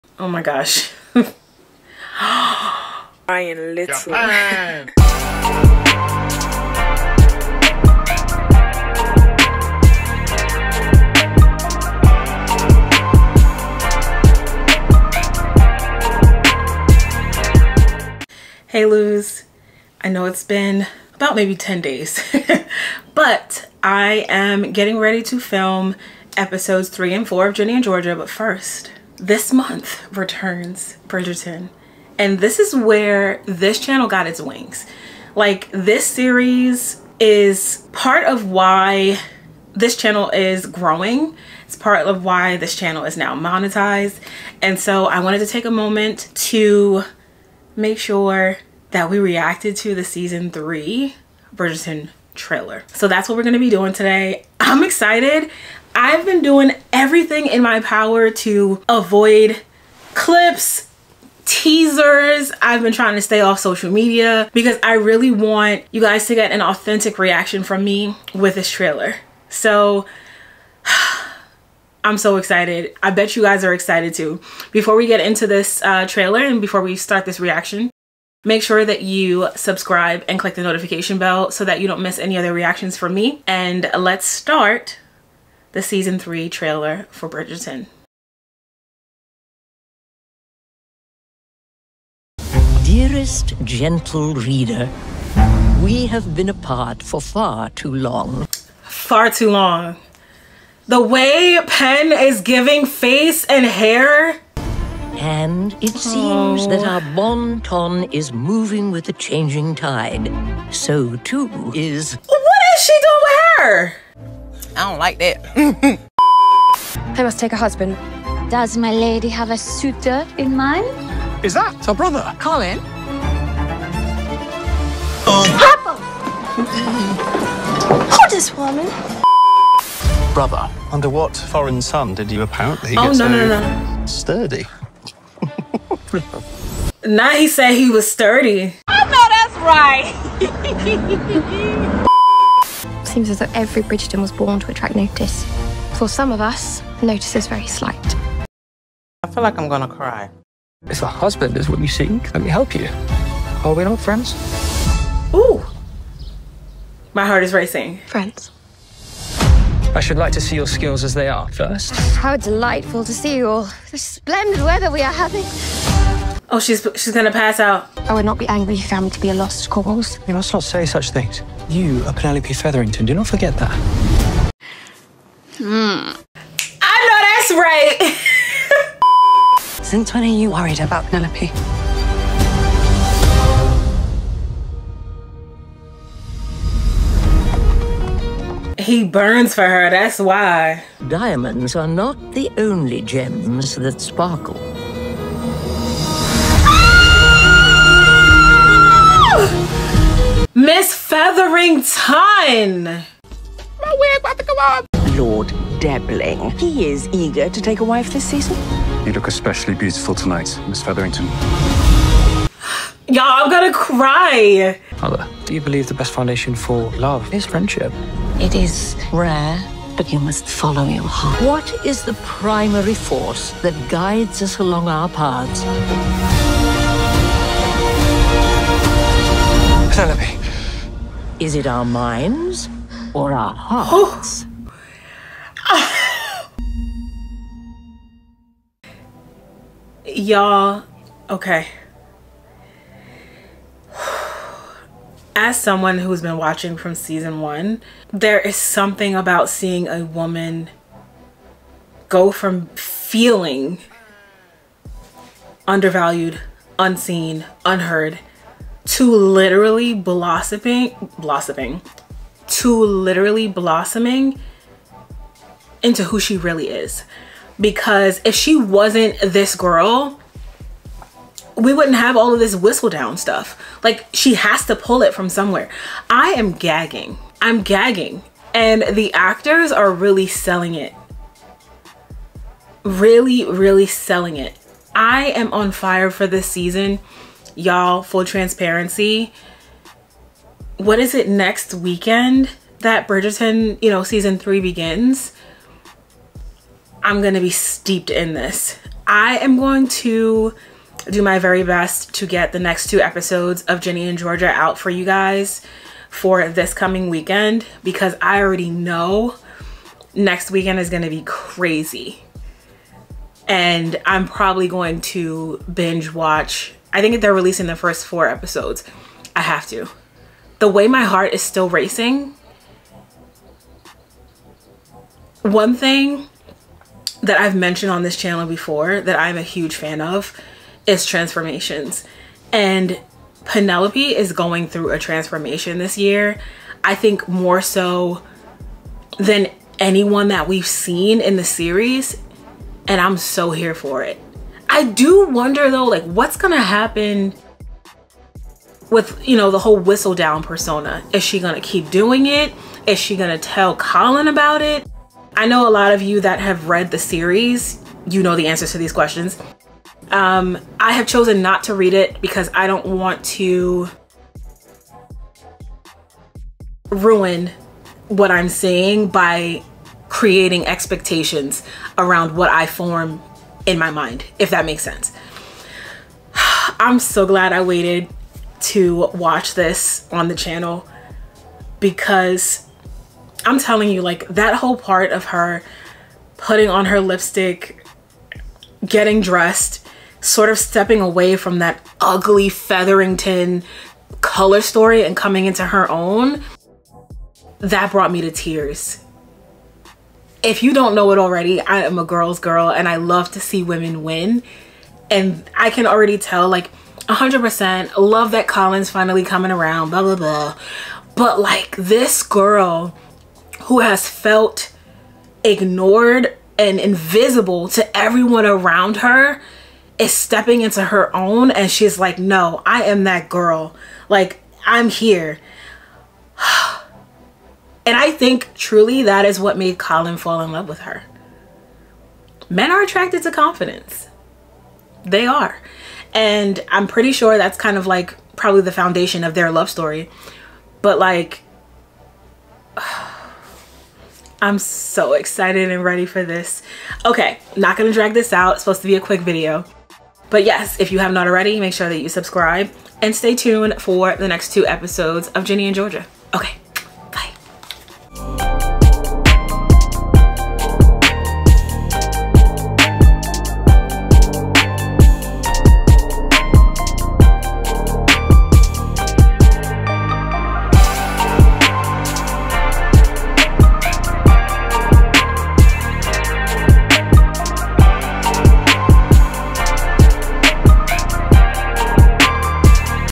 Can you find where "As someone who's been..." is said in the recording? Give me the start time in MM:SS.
04:05.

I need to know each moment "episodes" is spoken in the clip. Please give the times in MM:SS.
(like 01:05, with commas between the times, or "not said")
00:26, 05:03, 05:18, 07:34.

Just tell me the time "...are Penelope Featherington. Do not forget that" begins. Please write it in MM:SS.
02:52.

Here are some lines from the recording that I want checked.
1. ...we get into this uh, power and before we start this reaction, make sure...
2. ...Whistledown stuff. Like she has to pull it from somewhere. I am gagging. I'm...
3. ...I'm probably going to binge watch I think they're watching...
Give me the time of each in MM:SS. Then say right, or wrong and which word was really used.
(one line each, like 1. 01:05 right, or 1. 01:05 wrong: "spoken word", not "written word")
1. 01:14 wrong: "trailer", not "power"
2. 04:32 right
3. 05:14 wrong: "releasing", not "watching".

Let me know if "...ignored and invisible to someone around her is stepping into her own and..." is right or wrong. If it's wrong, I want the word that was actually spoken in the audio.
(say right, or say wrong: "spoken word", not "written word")
wrong: "everyone", not "someone".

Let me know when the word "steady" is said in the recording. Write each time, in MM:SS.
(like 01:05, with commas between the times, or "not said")
not said.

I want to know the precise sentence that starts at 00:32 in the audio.
And this is where this channel got its wings.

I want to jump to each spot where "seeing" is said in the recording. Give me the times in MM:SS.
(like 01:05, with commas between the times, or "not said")
04:09, 06:08.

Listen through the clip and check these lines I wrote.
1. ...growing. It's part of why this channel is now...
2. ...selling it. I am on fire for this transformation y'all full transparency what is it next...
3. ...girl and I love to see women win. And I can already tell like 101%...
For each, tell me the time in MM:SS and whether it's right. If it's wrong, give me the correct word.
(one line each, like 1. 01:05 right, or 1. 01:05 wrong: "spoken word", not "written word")
1. 00:40 right
2. 04:43 wrong: "season", not "transformation"
3. 06:42 wrong: "100", not "101".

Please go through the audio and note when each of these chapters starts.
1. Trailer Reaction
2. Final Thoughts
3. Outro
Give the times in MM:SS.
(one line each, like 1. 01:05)
1. 01:28
2. 03:59
3. 07:37.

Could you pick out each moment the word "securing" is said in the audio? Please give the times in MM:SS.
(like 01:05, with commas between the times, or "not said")
not said.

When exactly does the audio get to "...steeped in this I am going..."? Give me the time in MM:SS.
04:57.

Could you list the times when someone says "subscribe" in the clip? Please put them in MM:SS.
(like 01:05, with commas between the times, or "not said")
01:19, 07:32.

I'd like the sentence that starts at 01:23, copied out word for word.
And let's start the season three trailer for Bridgerton.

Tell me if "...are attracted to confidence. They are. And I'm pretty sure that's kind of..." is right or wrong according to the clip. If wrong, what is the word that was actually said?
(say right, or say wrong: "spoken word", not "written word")
right.